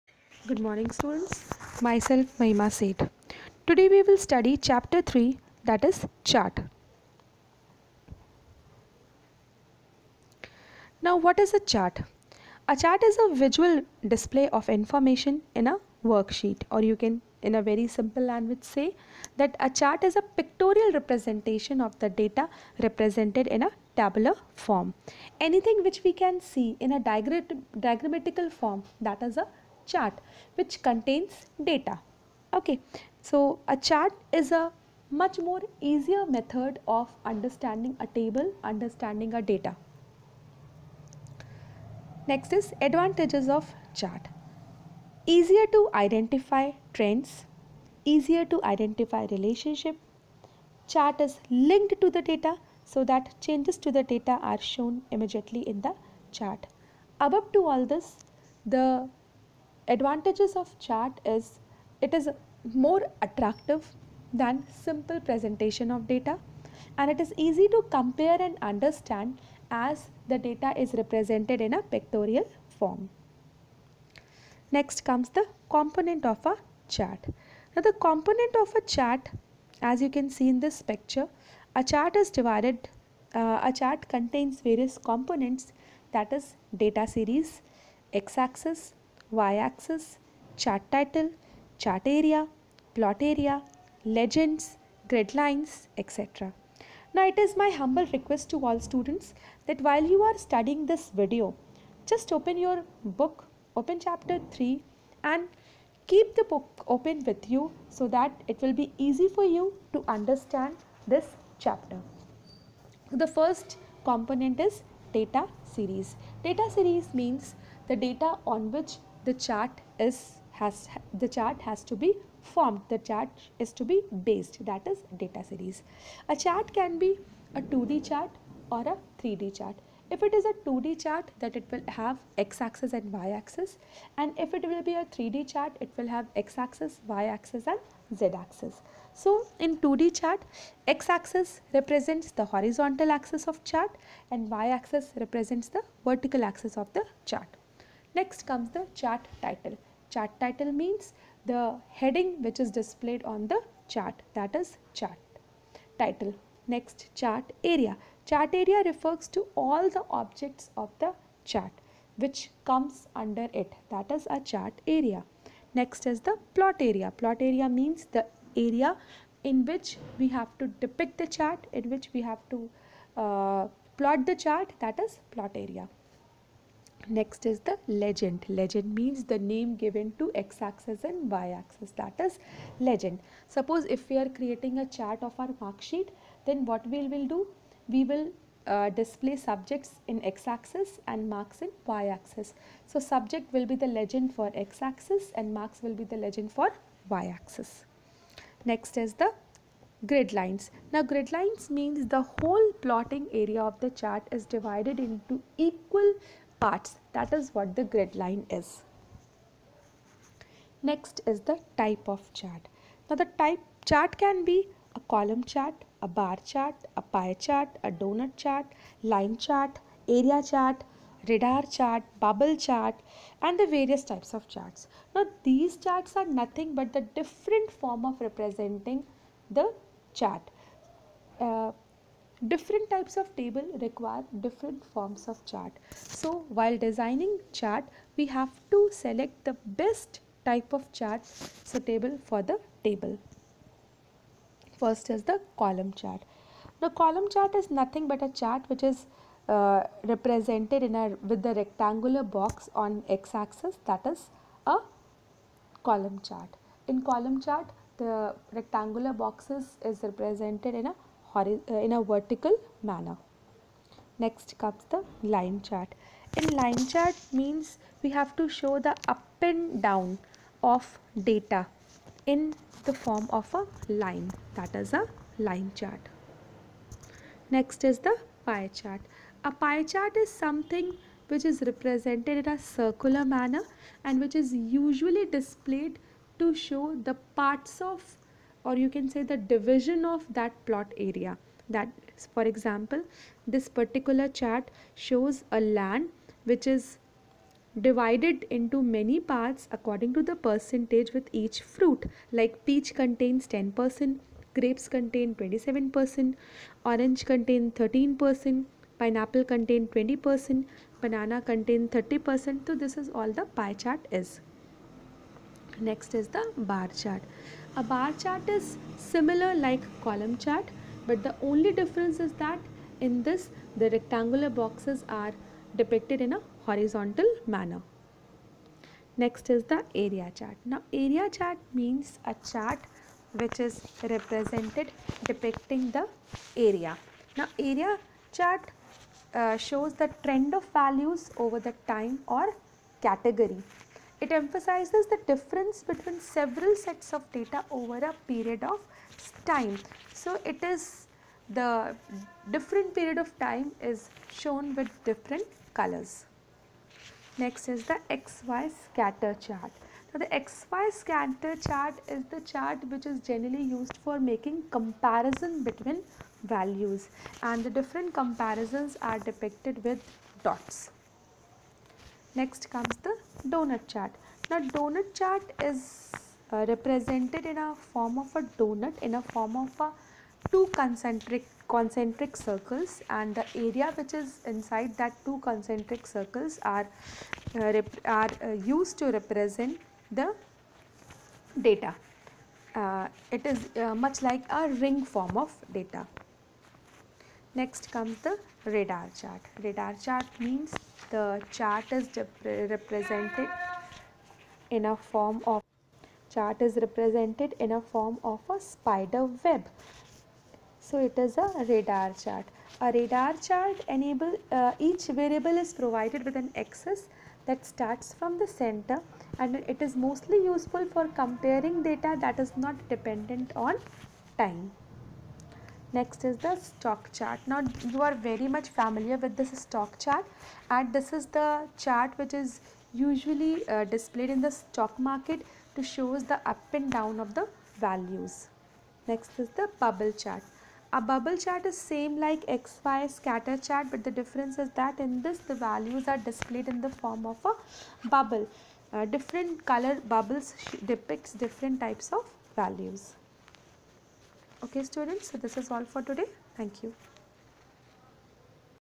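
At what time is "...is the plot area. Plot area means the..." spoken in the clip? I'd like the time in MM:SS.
02:46.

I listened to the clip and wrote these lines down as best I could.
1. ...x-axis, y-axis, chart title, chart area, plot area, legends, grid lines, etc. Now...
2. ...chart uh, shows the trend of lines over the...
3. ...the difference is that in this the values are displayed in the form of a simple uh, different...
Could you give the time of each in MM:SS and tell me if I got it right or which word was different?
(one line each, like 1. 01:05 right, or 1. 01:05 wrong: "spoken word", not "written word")
1. 01:28 right
2. 05:38 wrong: "values", not "lines"
3. 07:24 wrong: "bubble", not "simple".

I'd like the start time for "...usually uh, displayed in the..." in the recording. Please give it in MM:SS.
07:12.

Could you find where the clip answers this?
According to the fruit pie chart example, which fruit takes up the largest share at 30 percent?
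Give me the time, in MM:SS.
05:10.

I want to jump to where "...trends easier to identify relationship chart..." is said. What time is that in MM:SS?
00:46.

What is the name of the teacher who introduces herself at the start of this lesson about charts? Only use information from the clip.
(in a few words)
Mahima Seth.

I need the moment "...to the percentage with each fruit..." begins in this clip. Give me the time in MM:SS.
05:00.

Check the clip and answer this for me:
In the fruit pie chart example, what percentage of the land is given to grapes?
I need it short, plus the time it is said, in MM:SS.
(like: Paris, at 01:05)
27%, at 05:05.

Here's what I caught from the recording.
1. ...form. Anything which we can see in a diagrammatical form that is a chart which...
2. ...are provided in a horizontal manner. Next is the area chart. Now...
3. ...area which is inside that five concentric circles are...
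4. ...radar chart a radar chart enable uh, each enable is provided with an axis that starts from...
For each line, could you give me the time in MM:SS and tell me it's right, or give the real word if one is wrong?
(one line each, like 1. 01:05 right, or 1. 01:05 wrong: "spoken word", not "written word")
1. 00:24 right
2. 05:25 wrong: "depicted", not "provided"
3. 06:23 wrong: "two", not "five"
4. 06:51 wrong: "variable", not "enable".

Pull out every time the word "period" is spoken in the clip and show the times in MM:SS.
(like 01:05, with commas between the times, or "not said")
05:48, 05:52.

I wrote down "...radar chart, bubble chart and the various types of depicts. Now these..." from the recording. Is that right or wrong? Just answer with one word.
wrong.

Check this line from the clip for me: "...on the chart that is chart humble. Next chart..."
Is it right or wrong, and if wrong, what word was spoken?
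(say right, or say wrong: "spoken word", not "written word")
wrong: "title", not "humble".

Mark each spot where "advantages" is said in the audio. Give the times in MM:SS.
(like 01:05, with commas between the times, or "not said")
00:42, 00:59.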